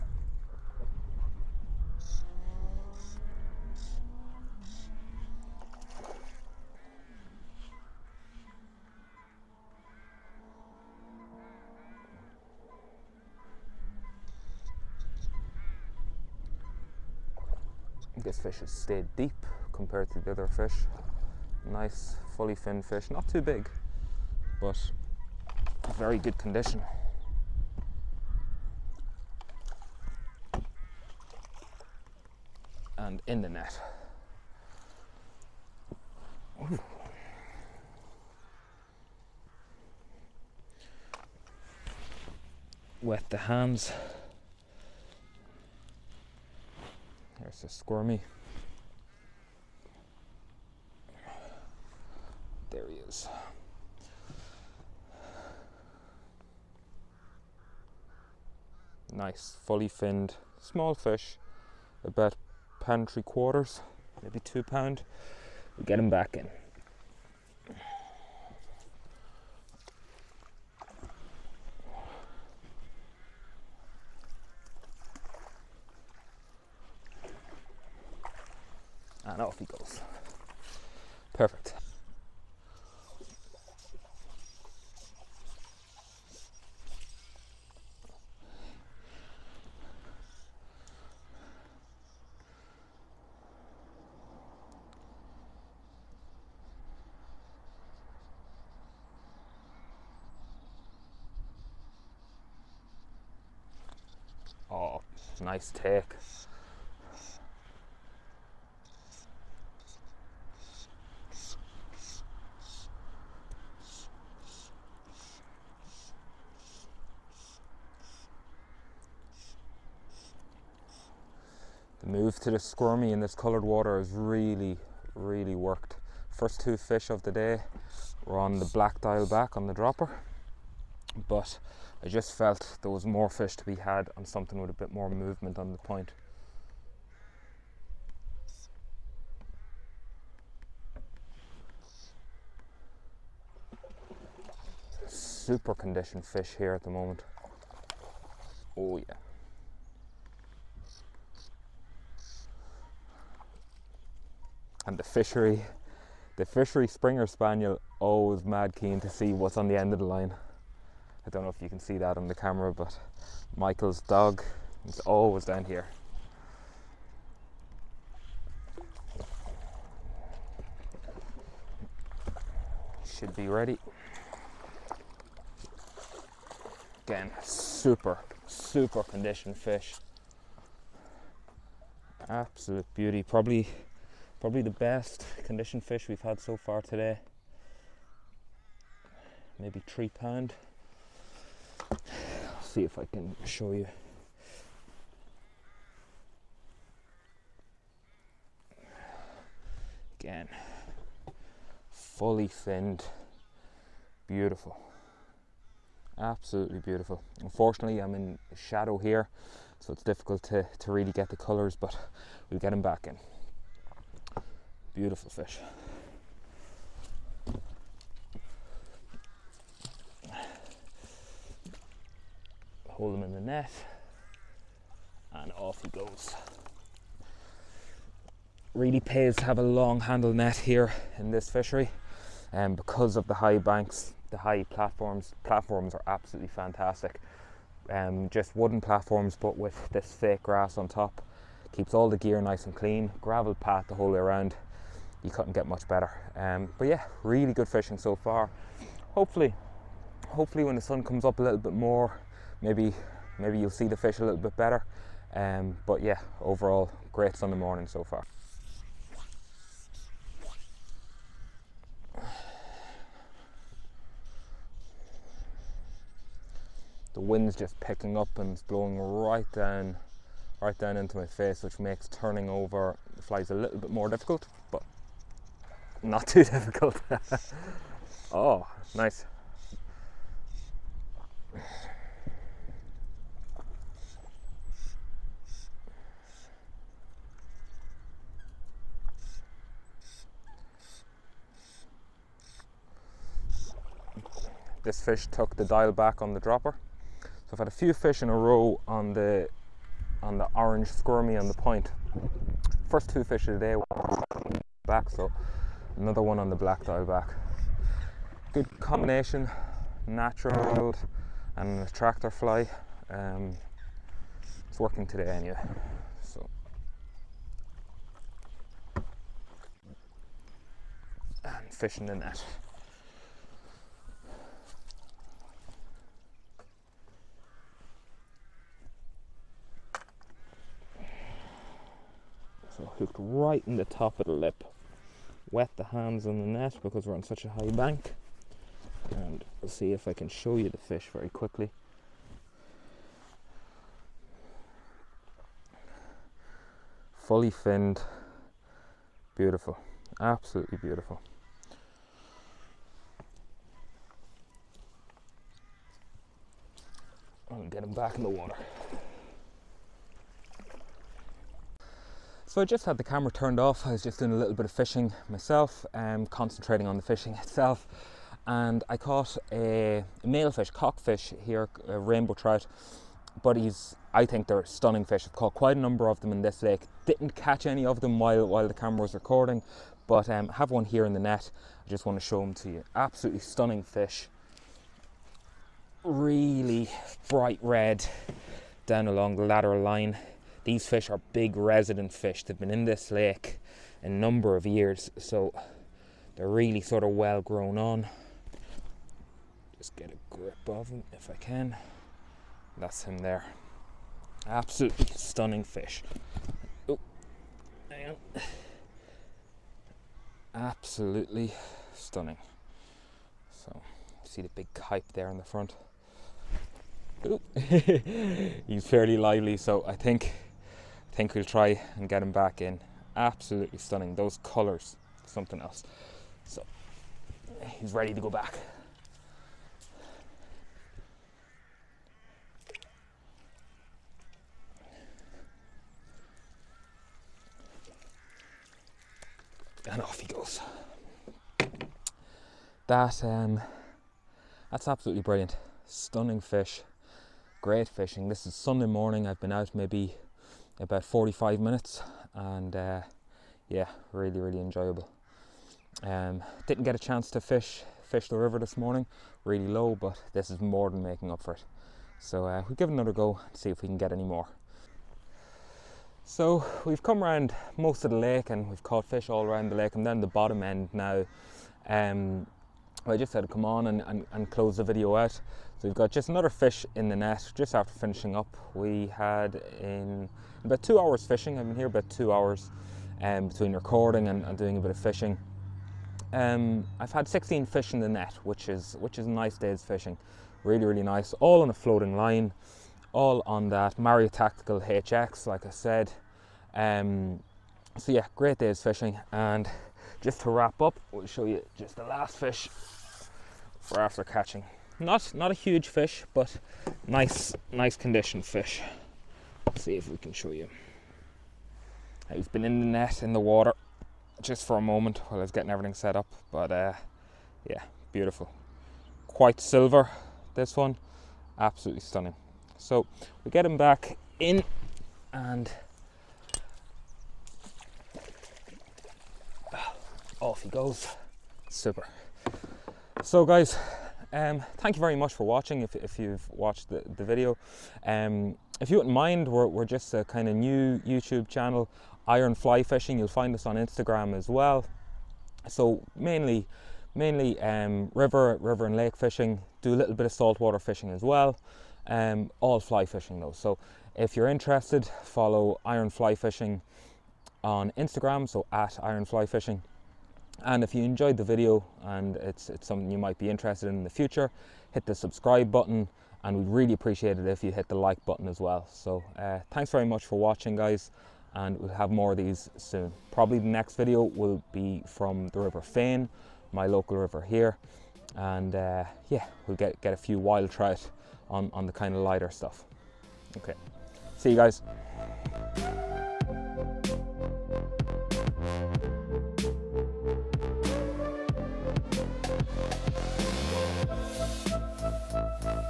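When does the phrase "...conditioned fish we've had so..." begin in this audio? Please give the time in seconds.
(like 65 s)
185 s.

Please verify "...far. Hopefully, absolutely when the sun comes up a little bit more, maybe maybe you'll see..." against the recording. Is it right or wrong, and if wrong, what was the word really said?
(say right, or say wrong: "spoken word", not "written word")
wrong: "hopefully", not "absolutely".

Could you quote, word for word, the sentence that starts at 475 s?
So we've got just another fish in the net just after finishing up.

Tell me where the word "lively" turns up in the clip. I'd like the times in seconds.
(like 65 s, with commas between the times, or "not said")
419 s.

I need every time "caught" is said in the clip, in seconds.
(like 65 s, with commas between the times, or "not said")
368 s, 375 s, 468 s.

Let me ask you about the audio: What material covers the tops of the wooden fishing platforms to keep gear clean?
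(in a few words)
fake grass.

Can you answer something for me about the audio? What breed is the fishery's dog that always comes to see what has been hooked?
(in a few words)
Springer Spaniel.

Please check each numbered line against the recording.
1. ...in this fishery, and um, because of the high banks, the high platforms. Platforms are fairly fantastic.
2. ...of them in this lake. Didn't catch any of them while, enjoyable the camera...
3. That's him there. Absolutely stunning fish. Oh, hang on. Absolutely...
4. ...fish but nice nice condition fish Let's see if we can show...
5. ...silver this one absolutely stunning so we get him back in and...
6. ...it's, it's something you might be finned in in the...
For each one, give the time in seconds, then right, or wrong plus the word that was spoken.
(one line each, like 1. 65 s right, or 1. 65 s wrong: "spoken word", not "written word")
1. 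231 s wrong: "absolutely", not "fairly"
2. 376 s wrong: "while", not "enjoyable"
3. 402 s right
4. 505 s right
5. 519 s right
6. 562 s wrong: "interested", not "finned".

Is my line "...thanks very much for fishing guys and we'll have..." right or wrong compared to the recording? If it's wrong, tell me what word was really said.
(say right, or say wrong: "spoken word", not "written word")
wrong: "watching", not "fishing".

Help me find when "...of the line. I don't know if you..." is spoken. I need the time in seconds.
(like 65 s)
159 s.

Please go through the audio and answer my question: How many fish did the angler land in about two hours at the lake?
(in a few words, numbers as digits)
16.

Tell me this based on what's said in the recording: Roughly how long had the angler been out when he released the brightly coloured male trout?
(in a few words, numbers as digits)
45 minutes.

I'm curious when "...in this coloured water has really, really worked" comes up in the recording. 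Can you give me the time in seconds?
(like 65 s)
123 s.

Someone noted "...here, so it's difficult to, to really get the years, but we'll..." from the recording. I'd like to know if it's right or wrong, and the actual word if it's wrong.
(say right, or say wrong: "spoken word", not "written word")
wrong: "colors", not "years".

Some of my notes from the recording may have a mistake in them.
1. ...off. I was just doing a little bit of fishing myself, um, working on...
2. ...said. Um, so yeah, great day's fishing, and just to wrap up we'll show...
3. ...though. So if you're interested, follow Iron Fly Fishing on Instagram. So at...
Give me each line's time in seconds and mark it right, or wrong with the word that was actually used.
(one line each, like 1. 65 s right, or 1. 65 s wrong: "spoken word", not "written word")
1. 363 s wrong: "concentrating", not "working"
2. 495 s right
3. 553 s right.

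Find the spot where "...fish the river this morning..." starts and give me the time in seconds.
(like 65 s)
458 s.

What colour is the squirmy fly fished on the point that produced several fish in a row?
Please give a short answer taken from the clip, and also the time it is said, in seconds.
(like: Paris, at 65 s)
orange, at 300 s.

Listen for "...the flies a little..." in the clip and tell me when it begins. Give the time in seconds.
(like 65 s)
273 s.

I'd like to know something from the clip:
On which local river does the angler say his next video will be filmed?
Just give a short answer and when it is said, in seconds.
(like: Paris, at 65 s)
River Fane, at 575 s.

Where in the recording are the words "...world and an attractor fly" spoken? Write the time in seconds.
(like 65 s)
310 s.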